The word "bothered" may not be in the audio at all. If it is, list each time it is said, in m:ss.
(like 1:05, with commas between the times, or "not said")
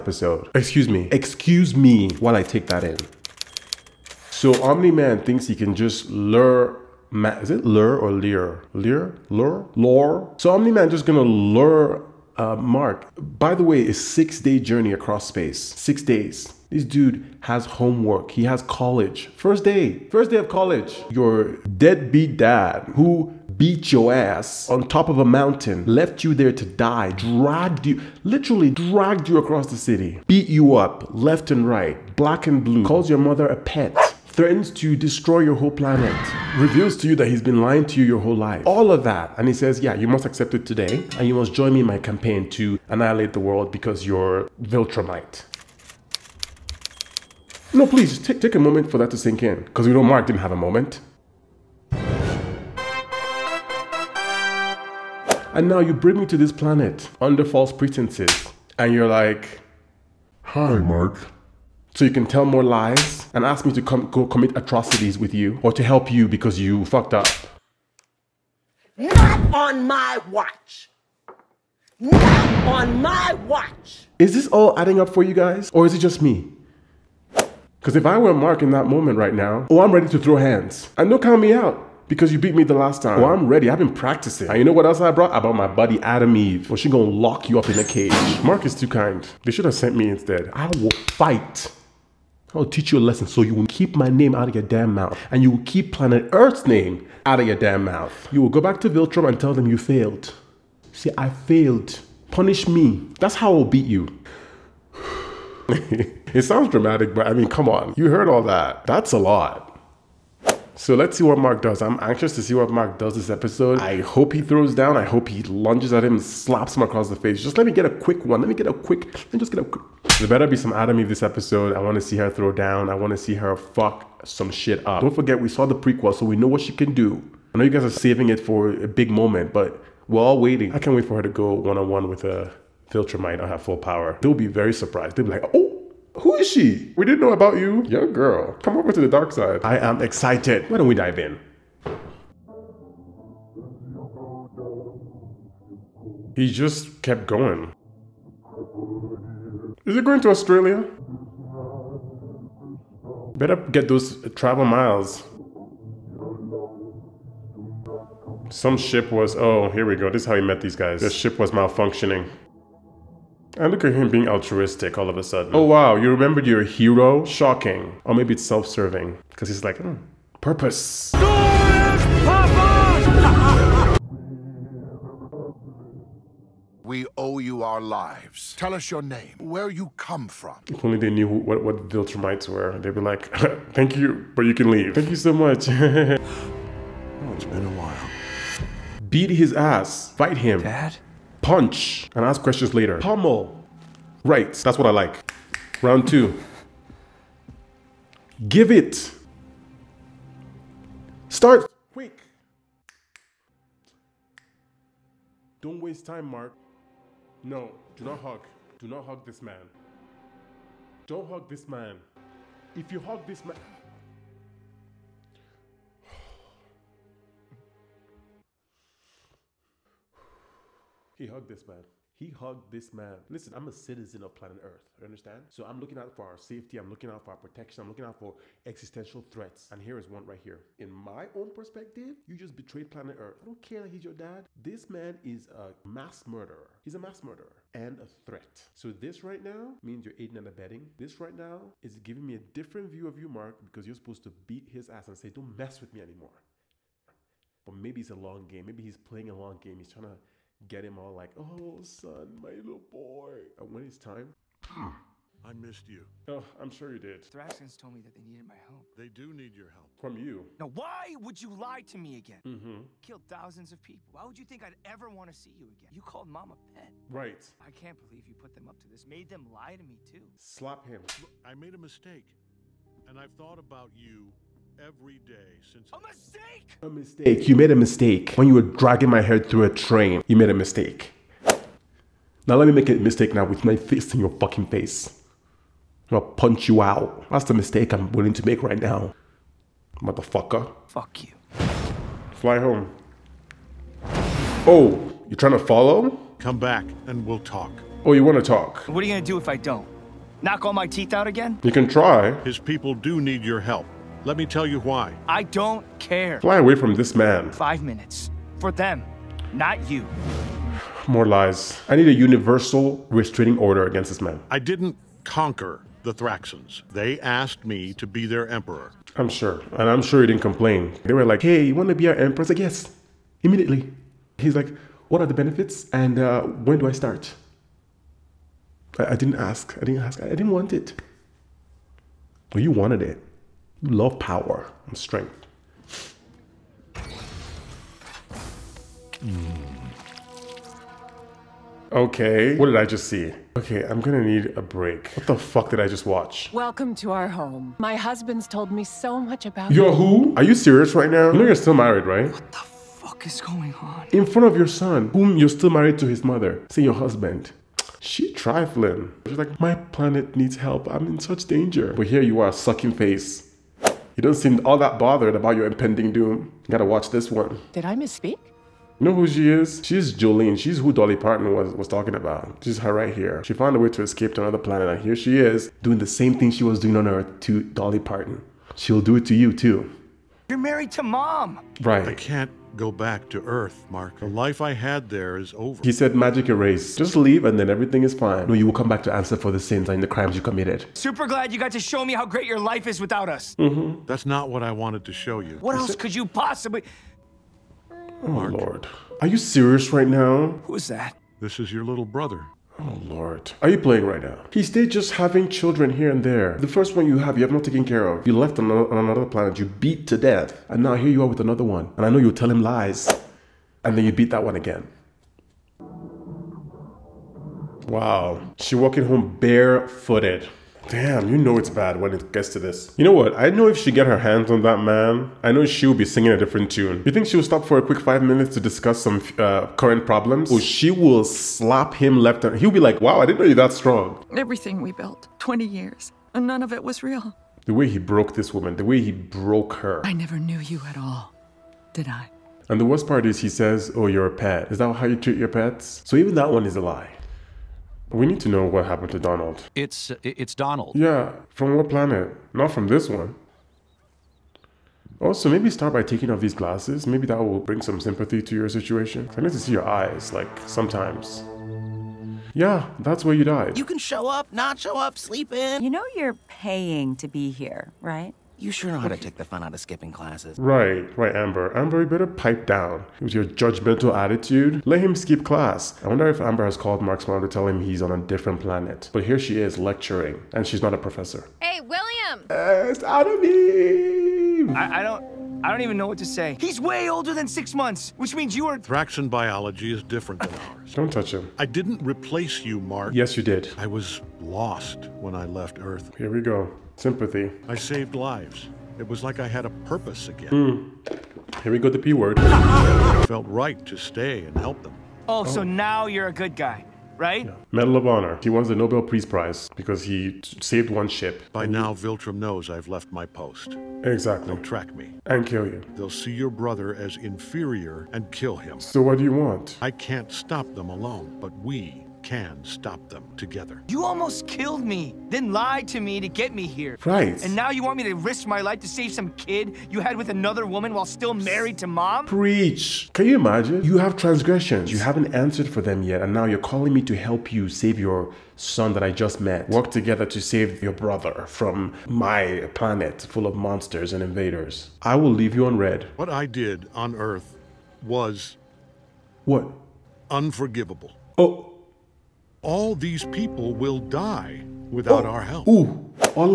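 6:04.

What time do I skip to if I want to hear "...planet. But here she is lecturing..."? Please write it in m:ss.
7:58.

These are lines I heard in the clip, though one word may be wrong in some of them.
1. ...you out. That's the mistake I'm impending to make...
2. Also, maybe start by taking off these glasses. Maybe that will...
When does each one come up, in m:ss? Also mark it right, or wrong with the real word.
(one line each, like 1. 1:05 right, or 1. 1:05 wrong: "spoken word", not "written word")
1. 4:46 wrong: "willing", not "impending"
2. 7:35 right.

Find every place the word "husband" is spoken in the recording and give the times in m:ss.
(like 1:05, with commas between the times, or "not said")
5:47, 5:56.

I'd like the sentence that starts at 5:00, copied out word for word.
Knock all my teeth out again?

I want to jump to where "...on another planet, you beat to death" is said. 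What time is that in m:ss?
6:48.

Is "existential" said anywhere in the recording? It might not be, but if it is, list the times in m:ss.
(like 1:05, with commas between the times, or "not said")
3:48.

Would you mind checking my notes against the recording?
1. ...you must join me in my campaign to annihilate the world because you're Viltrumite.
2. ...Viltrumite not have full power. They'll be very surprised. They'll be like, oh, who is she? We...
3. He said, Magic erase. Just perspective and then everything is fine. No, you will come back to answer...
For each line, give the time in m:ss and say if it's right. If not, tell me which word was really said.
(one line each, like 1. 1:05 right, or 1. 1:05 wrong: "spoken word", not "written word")
1. 0:41 right
2. 2:12 right
3. 6:25 wrong: "leave", not "perspective".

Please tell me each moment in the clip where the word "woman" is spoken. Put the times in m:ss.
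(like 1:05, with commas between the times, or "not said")
7:18, 8:50.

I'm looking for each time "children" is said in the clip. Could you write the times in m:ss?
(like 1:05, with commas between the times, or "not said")
6:45.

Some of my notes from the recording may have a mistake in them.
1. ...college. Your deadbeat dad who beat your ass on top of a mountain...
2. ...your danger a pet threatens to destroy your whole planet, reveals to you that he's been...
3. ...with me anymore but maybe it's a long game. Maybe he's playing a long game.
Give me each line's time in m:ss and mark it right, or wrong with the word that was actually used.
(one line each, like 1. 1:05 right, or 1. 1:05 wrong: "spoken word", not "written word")
1. 0:20 right
2. 0:33 wrong: "mother", not "danger"
3. 4:05 right.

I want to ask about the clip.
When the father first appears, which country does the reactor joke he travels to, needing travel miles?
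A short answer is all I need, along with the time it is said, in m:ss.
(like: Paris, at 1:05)
Australia, at 2:30.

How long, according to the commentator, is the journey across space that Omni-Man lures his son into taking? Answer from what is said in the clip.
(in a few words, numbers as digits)
6 days.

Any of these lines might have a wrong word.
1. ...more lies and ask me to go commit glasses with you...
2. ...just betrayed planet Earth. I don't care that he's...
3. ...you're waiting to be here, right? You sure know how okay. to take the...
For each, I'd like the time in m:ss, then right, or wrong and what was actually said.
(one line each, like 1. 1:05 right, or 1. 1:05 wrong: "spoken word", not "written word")
1. 1:02 wrong: "atrocities", not "glasses"
2. 3:52 right
3. 7:46 wrong: "paying", not "waiting".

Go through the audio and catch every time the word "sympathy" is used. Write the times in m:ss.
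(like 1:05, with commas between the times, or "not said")
7:37, 8:16.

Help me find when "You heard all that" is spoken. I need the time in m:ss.
1:47.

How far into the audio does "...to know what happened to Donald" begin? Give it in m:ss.
7:28.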